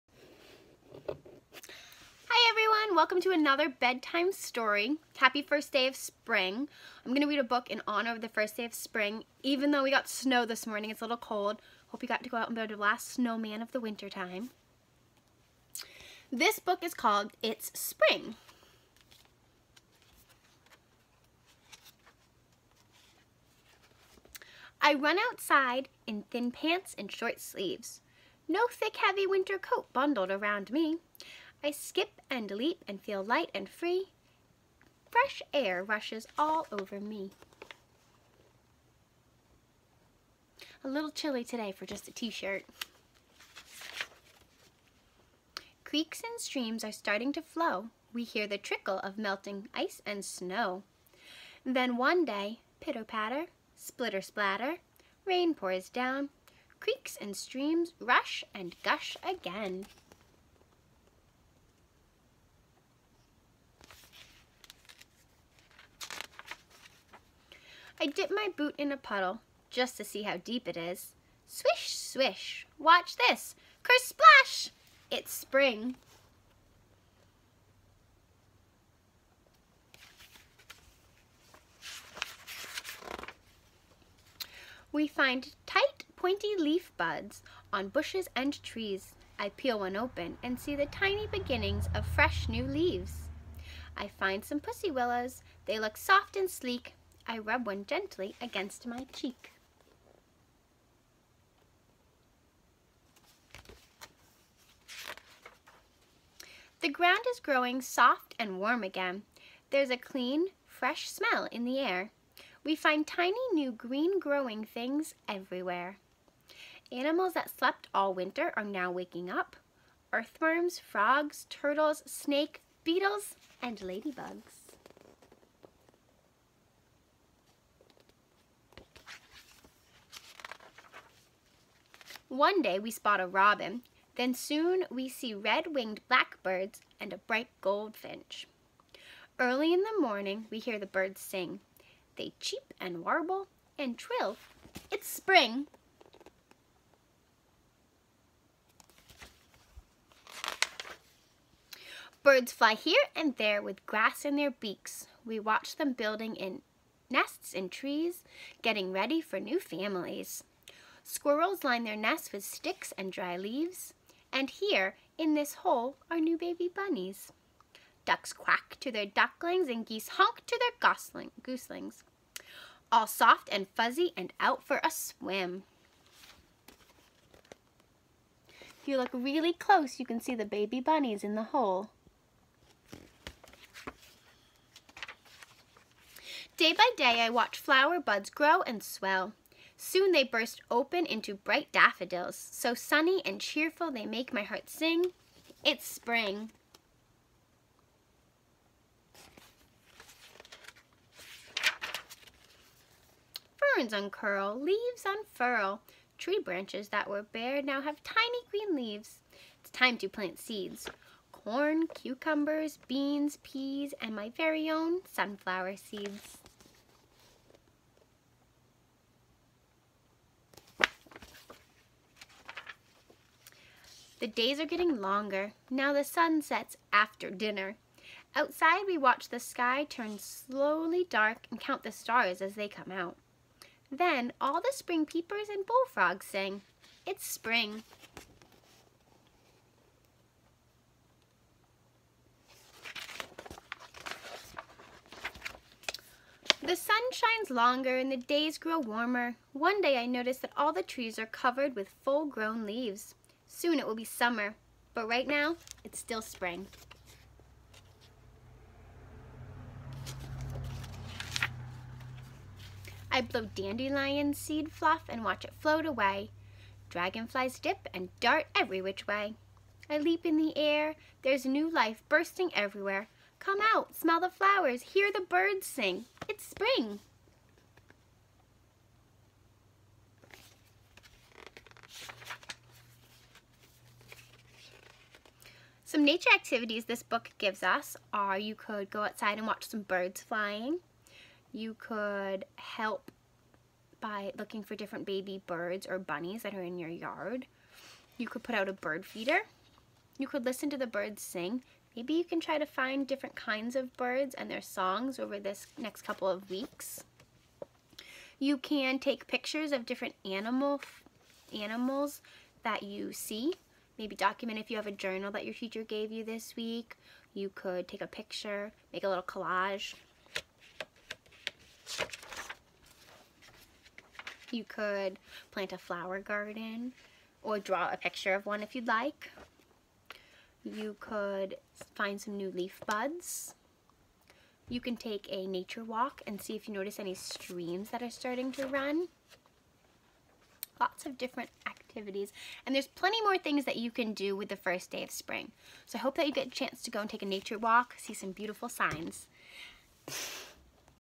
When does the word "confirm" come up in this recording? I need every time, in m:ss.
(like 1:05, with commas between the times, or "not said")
not said.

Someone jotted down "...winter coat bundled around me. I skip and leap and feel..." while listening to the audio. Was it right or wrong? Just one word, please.
right.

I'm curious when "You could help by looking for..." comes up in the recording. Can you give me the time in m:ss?
4:51.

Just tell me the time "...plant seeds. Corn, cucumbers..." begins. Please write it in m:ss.
3:30.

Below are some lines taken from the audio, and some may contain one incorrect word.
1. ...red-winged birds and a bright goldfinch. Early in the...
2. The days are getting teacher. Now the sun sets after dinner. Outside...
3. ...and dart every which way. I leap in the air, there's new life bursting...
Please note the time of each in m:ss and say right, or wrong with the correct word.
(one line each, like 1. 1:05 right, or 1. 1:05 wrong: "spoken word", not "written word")
1. 2:15 wrong: "blackbirds", not "birds"
2. 3:44 wrong: "longer", not "teacher"
3. 4:27 right.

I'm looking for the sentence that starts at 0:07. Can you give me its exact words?
I'm gonna read a book in honor of the first day of spring.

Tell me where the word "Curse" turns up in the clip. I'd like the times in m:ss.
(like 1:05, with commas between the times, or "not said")
1:13.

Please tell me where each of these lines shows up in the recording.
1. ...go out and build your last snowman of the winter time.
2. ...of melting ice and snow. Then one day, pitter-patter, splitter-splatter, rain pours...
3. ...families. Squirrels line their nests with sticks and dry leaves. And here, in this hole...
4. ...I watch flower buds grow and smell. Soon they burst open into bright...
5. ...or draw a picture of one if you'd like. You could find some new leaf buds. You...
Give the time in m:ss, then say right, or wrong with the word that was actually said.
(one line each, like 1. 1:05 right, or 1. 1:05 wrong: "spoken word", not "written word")
1. 0:12 right
2. 0:48 right
3. 2:39 right
4. 3:07 wrong: "swell", not "smell"
5. 5:27 right.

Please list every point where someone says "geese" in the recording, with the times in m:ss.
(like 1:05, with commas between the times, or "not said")
2:49.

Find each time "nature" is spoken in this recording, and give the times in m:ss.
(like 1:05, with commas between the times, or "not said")
4:46, 5:35, 5:47.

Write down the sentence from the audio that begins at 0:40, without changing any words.
A little chilly today for just a t-shirt.